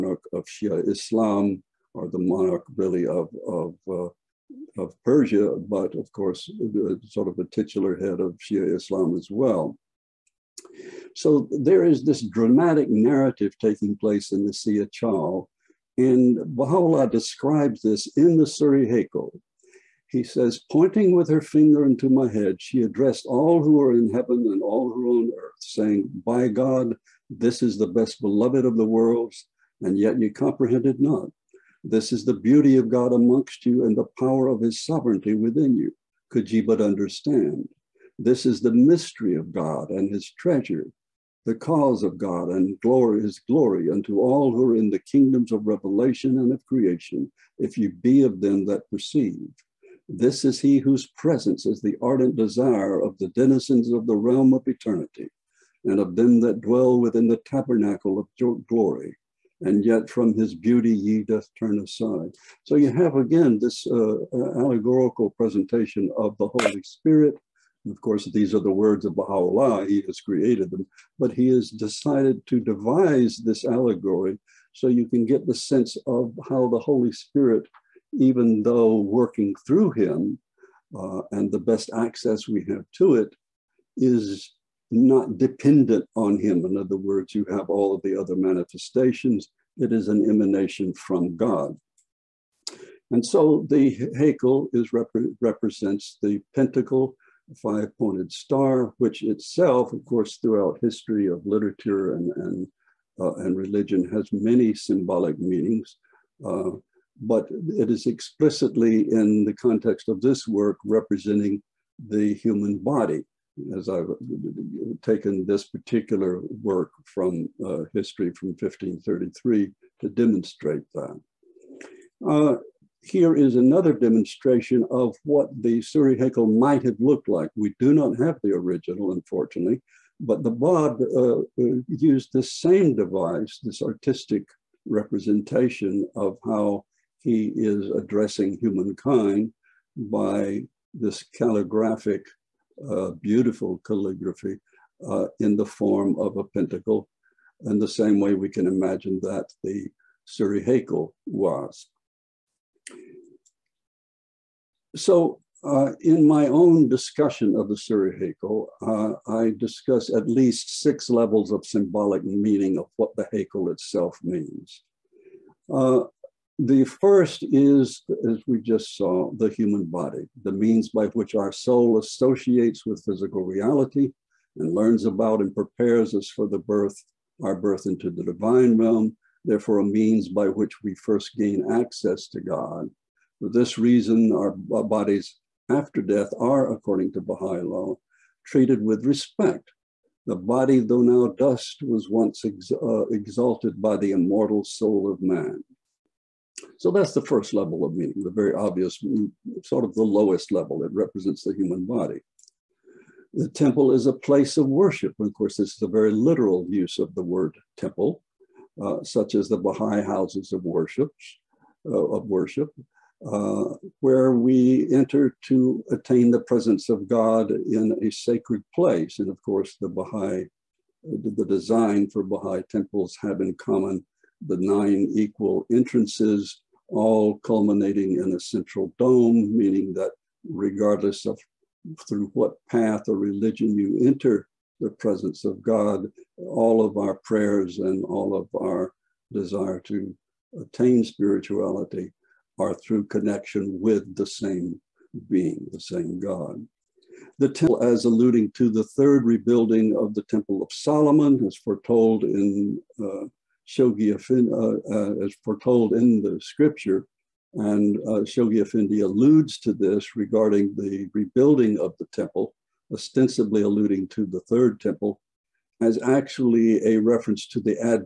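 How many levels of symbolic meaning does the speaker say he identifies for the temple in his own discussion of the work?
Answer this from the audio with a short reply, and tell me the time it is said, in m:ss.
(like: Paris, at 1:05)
6, at 2:40.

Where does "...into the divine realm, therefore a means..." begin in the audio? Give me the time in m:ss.
2:57.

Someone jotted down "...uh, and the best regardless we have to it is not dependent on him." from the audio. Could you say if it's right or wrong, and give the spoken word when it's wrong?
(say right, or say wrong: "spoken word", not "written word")
wrong: "access", not "regardless".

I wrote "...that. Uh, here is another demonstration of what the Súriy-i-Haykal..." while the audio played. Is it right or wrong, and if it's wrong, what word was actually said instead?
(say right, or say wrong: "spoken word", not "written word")
right.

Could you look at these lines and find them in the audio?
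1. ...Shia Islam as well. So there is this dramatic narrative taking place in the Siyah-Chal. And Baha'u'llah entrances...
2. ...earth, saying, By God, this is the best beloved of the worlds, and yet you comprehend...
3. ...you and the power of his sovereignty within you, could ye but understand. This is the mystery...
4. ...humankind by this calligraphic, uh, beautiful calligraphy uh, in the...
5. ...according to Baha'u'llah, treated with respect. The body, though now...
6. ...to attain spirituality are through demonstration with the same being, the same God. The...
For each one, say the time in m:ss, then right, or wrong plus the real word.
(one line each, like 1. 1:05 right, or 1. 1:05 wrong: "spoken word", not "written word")
1. 0:08 wrong: "describes", not "entrances"
2. 0:25 right
3. 0:33 right
4. 2:18 right
5. 3:06 right
6. 3:59 wrong: "connection", not "demonstration".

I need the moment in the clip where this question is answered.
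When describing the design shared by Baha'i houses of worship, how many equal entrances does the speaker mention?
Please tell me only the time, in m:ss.
3:44.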